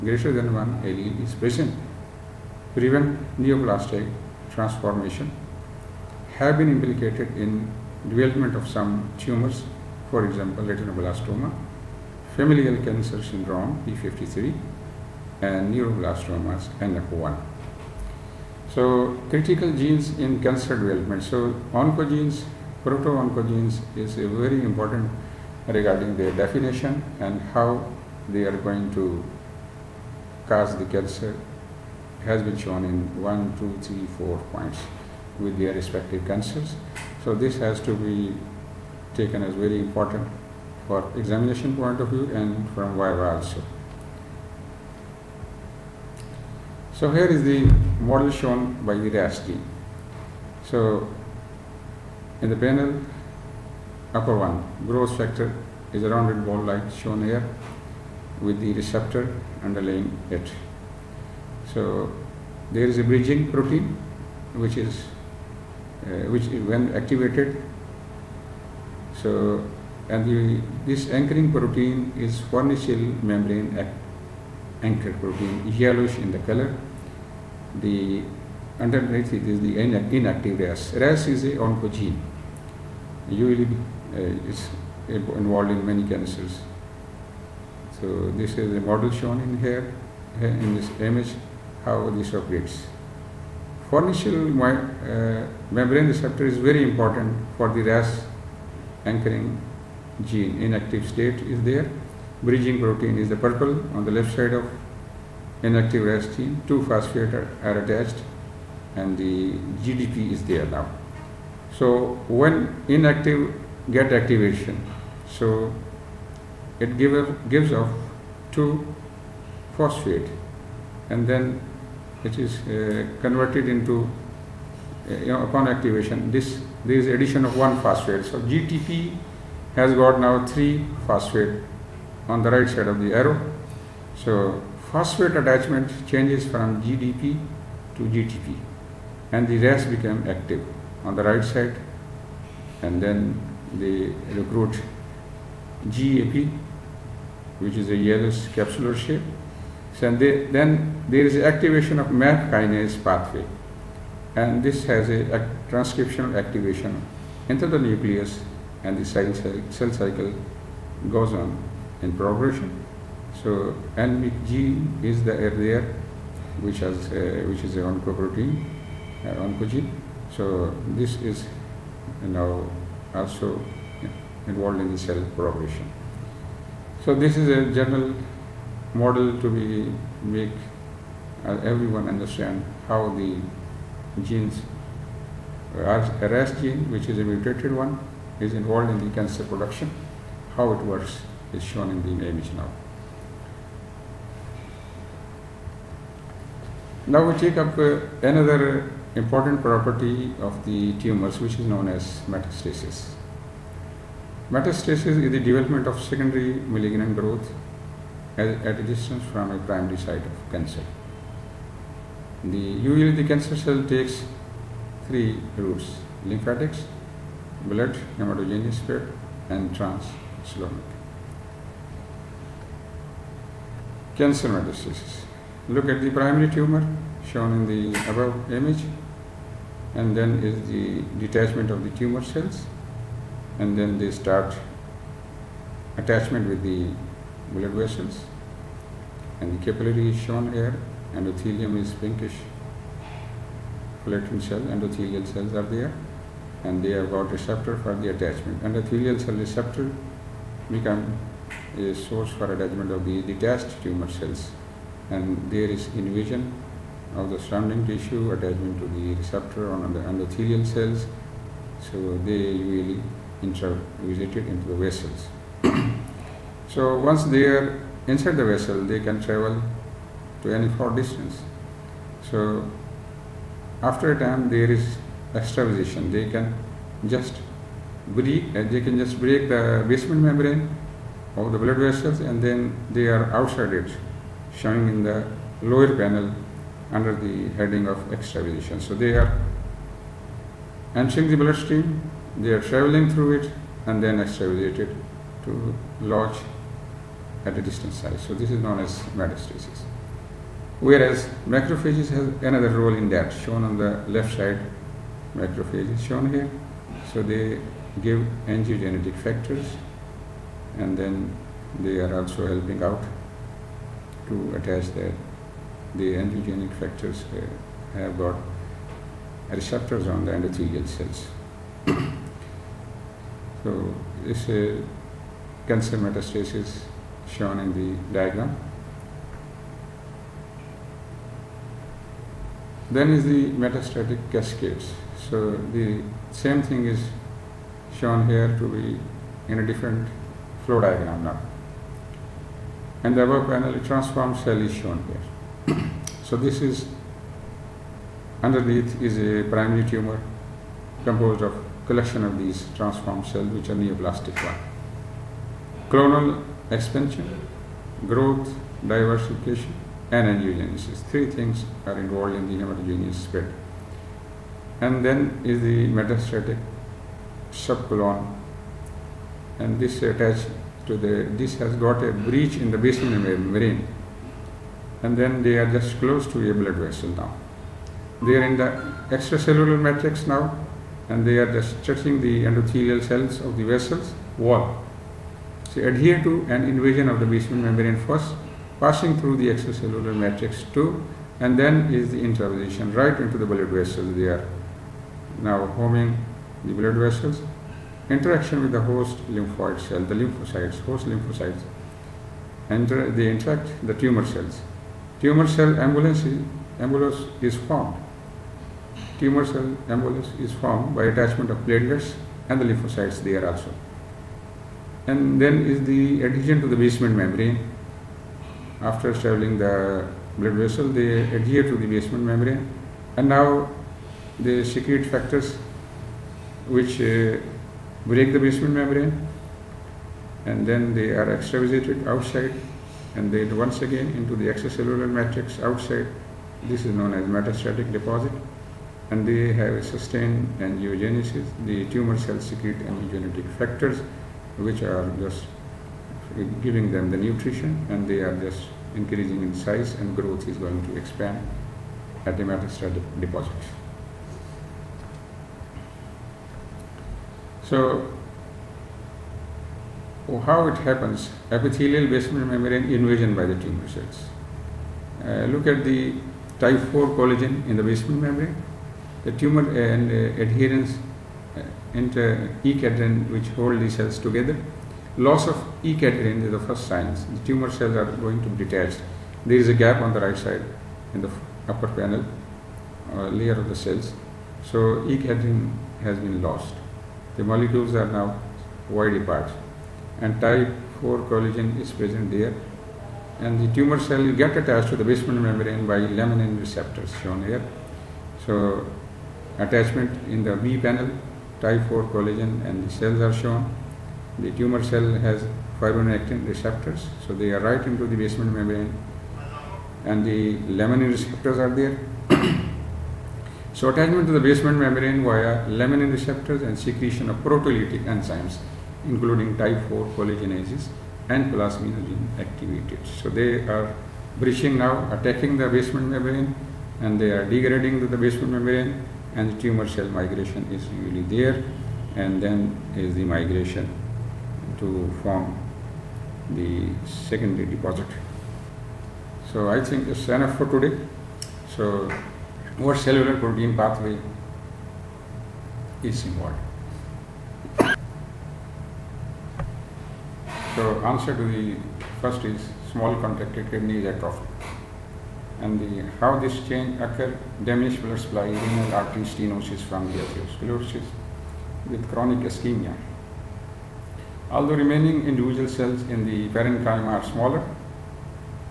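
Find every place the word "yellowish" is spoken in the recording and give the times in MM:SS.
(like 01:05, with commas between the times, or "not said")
01:15, 02:27.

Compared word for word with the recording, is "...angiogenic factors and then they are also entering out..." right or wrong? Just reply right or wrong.
wrong.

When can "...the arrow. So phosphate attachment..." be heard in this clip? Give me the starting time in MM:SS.
02:12.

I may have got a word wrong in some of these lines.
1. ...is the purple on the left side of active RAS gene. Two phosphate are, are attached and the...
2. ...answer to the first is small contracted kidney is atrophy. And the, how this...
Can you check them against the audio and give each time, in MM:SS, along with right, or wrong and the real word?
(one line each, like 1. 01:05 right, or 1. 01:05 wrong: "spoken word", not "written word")
1. 01:43 wrong: "inactive", not "active"
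2. 09:11 right.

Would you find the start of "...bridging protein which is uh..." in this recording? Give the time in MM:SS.
01:03.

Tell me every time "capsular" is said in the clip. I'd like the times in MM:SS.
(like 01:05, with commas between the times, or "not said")
02:28.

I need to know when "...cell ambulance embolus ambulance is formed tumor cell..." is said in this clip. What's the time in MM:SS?
06:45.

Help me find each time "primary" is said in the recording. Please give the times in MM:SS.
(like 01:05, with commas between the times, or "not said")
03:29, 03:46, 05:49.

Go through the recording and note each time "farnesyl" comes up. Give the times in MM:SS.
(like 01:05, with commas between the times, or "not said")
01:12, 01:33.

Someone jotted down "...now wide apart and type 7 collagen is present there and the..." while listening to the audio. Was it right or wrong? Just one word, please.
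wrong.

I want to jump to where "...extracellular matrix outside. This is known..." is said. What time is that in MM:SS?
07:14.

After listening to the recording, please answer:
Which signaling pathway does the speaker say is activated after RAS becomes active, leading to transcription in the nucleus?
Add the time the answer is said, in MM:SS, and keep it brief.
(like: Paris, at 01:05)
MAP kinase pathway, at 02:32.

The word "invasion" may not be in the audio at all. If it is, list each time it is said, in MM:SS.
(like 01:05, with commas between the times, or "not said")
04:16, 06:26, 07:42.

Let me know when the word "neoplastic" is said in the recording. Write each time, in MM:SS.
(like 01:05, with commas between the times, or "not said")
00:03, 05:53.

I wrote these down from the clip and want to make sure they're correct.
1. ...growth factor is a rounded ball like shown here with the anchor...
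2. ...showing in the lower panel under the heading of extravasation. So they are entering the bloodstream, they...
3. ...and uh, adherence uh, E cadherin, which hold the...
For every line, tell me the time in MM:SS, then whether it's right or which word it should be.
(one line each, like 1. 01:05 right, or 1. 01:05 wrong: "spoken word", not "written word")
1. 00:54 wrong: "receptor", not "anchor"
2. 04:44 right
3. 07:49 right.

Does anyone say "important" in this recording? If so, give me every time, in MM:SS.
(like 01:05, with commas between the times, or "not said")
00:24, 00:39, 01:36, 03:19.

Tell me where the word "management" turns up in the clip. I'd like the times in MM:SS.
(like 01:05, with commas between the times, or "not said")
not said.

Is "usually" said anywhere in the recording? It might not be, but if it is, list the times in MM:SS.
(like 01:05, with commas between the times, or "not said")
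01:23, 03:32, 04:22, 08:51.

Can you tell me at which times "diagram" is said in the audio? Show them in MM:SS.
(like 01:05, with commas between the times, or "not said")
05:28, 05:40.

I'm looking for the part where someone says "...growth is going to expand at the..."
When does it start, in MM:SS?
07:30.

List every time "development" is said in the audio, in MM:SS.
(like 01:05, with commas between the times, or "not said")
00:08, 00:20, 03:25.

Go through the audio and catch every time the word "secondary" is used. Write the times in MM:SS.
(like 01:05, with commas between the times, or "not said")
03:26, 08:57.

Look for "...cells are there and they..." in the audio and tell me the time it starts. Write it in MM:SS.
04:05.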